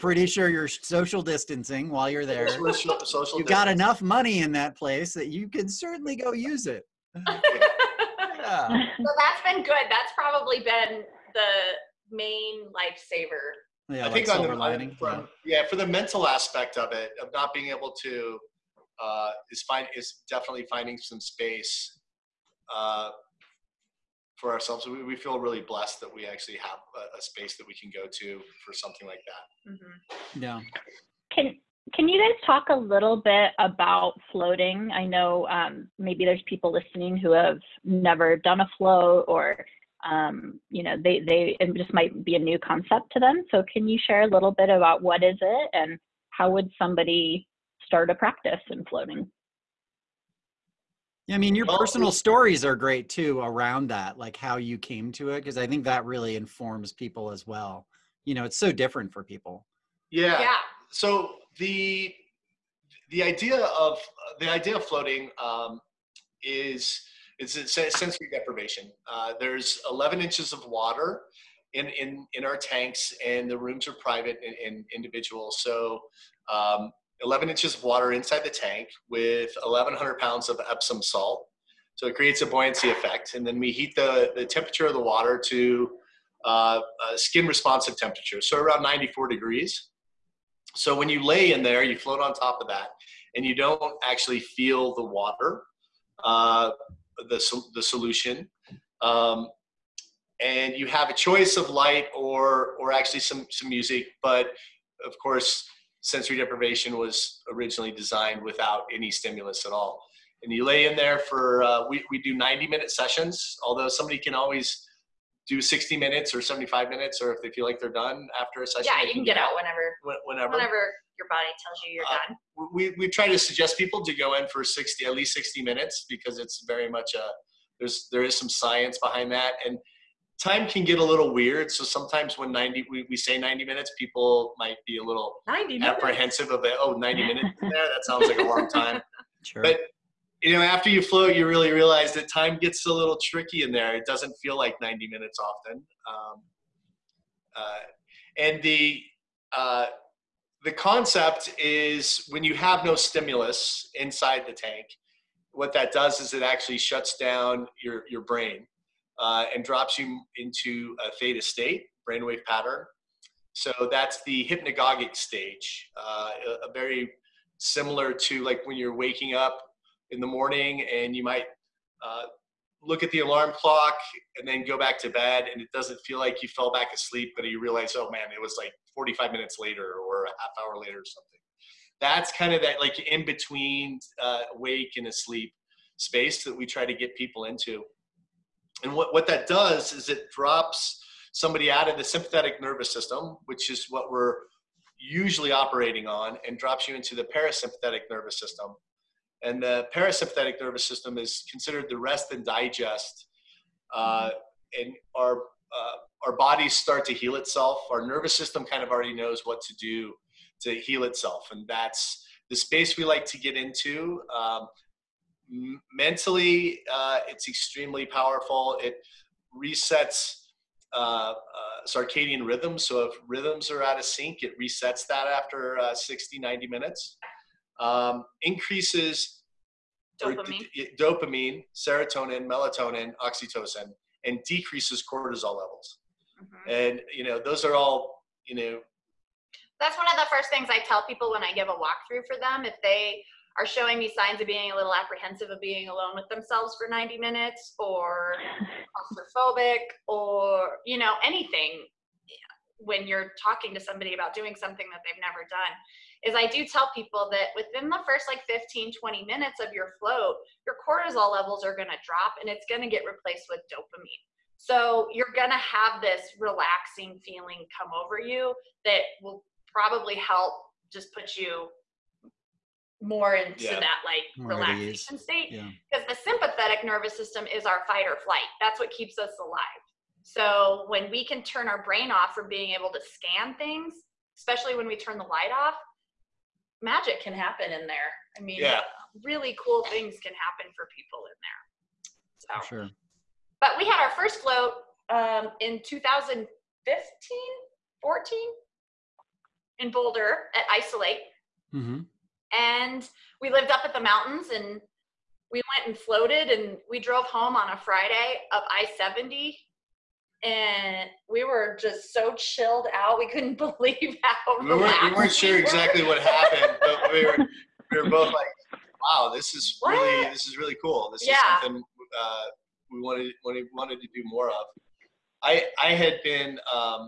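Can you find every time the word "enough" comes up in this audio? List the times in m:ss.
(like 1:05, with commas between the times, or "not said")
0:03.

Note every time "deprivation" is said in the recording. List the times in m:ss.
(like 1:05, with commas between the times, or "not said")
1:08, 1:46.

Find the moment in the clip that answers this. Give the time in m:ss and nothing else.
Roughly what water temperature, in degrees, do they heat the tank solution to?
1:28.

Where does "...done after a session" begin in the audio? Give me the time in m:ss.
1:57.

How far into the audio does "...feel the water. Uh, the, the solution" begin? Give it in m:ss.
1:34.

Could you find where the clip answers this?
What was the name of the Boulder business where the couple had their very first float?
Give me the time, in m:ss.
5:00.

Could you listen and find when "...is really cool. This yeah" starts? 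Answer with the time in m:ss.
5:20.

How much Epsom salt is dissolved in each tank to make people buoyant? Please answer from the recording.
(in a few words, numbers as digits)
1,100 pounds.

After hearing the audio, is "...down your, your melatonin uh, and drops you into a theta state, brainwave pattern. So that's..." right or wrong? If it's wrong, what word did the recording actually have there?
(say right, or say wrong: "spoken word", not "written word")
wrong: "brain", not "melatonin".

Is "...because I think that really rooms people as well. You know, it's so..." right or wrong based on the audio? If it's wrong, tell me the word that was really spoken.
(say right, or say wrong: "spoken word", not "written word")
wrong: "informs", not "rooms".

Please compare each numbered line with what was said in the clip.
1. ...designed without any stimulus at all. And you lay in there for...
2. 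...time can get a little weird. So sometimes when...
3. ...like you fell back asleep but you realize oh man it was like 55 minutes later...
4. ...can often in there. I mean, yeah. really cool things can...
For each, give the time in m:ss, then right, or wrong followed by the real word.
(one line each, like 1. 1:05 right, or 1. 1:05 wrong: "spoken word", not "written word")
1. 1:47 right
2. 2:10 right
3. 2:56 wrong: "45", not "55"
4. 4:47 wrong: "happen", not "often".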